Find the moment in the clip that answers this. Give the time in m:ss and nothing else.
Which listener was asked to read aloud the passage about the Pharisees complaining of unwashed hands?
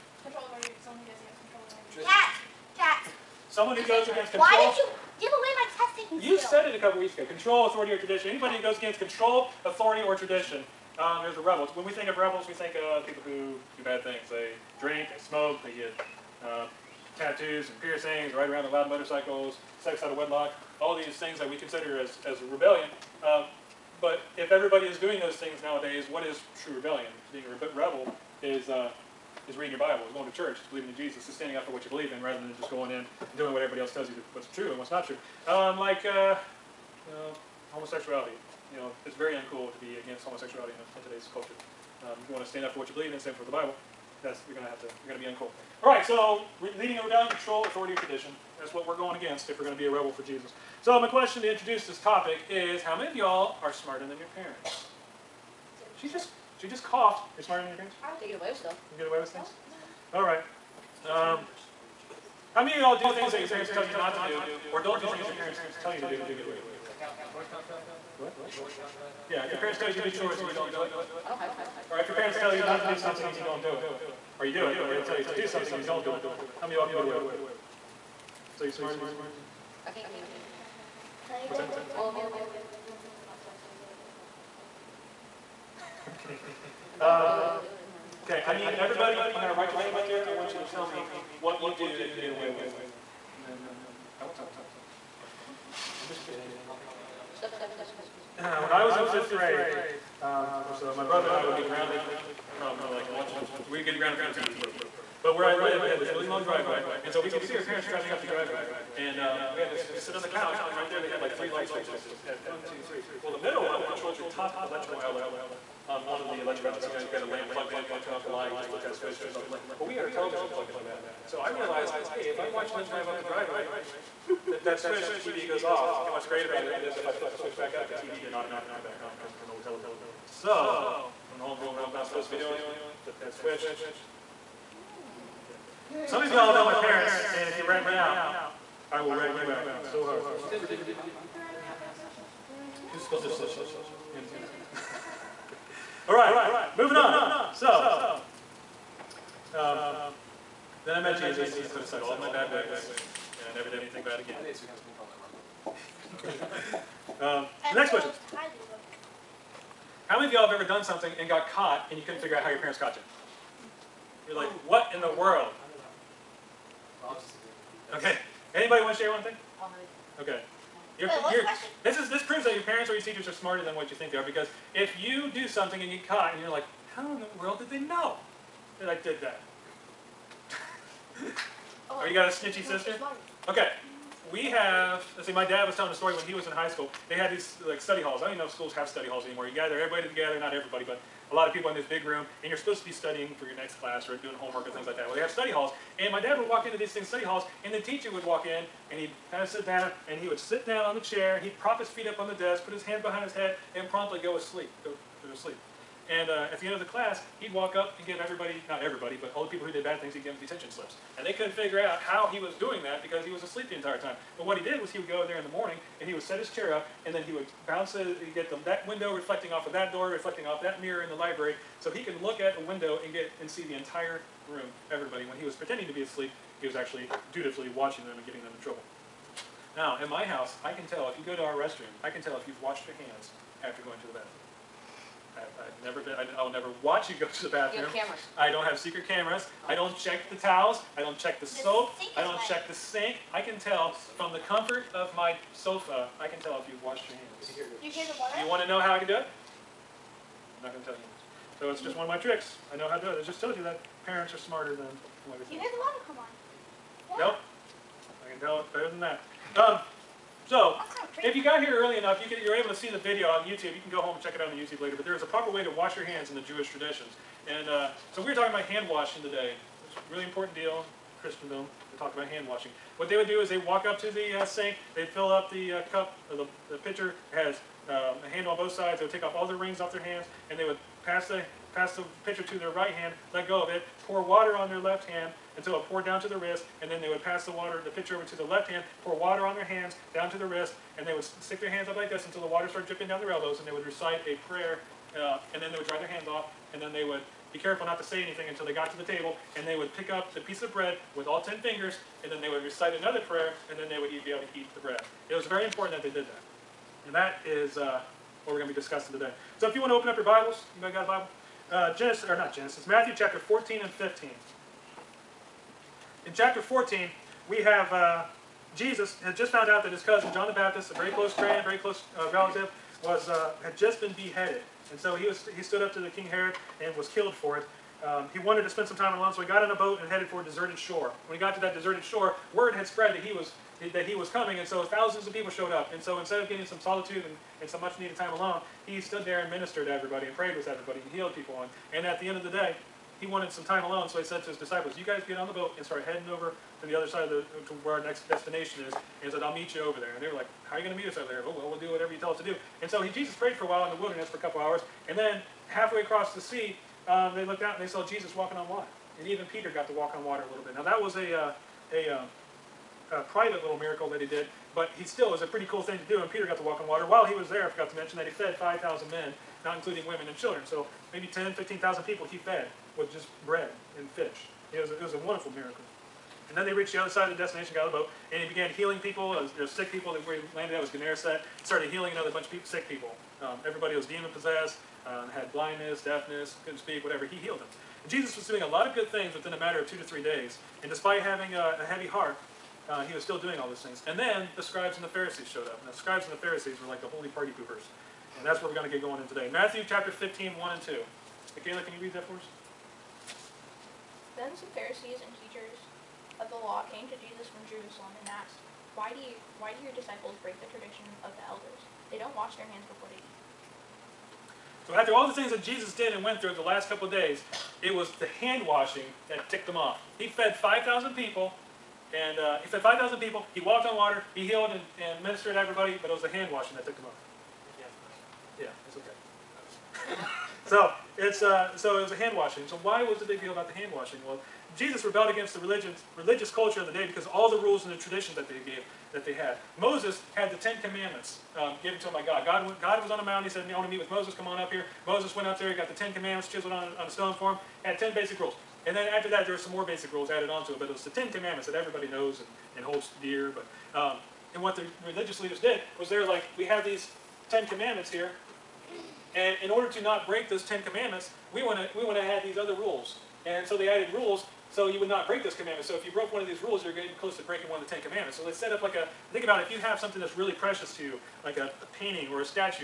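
6:41.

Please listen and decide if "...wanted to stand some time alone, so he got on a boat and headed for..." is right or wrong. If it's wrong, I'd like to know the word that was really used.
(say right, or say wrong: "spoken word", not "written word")
wrong: "spend", not "stand".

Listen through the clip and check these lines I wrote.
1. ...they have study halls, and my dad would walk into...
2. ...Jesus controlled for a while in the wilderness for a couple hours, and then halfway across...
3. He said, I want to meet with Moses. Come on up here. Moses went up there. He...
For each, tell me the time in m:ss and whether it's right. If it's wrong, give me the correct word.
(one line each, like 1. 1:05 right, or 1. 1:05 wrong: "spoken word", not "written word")
1. 3:15 right
2. 5:53 wrong: "prayed", not "controlled"
3. 7:23 right.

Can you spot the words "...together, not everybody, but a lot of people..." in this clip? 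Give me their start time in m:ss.
3:10.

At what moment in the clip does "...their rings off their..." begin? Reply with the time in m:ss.
4:39.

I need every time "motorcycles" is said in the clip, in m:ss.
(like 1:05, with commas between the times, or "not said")
0:18.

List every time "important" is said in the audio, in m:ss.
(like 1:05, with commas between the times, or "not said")
4:30, 5:05.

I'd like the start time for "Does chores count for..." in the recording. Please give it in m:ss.
1:07.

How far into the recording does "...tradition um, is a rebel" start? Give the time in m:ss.
0:10.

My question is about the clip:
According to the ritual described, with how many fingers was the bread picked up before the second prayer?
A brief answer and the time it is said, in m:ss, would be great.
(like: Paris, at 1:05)
10, at 5:01.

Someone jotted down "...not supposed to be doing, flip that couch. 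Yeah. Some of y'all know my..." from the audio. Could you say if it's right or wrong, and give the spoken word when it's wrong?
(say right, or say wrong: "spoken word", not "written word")
wrong: "switch", not "couch".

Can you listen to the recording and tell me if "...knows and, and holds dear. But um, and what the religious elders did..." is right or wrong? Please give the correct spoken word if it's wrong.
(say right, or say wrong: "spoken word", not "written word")
wrong: "leaders", not "elders".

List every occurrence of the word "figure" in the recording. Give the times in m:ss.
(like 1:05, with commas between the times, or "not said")
2:42, 3:31.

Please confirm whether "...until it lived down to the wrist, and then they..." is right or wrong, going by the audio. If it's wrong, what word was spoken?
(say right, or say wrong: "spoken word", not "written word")
wrong: "poured", not "lived".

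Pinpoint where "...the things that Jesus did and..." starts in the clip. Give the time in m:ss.
6:55.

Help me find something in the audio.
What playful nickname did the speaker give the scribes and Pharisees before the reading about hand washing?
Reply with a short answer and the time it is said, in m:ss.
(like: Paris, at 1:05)
Holy party poopers, at 6:37.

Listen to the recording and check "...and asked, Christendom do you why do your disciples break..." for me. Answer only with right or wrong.
wrong.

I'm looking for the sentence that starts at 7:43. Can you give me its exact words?
And so they added rules so you would not break those commandments.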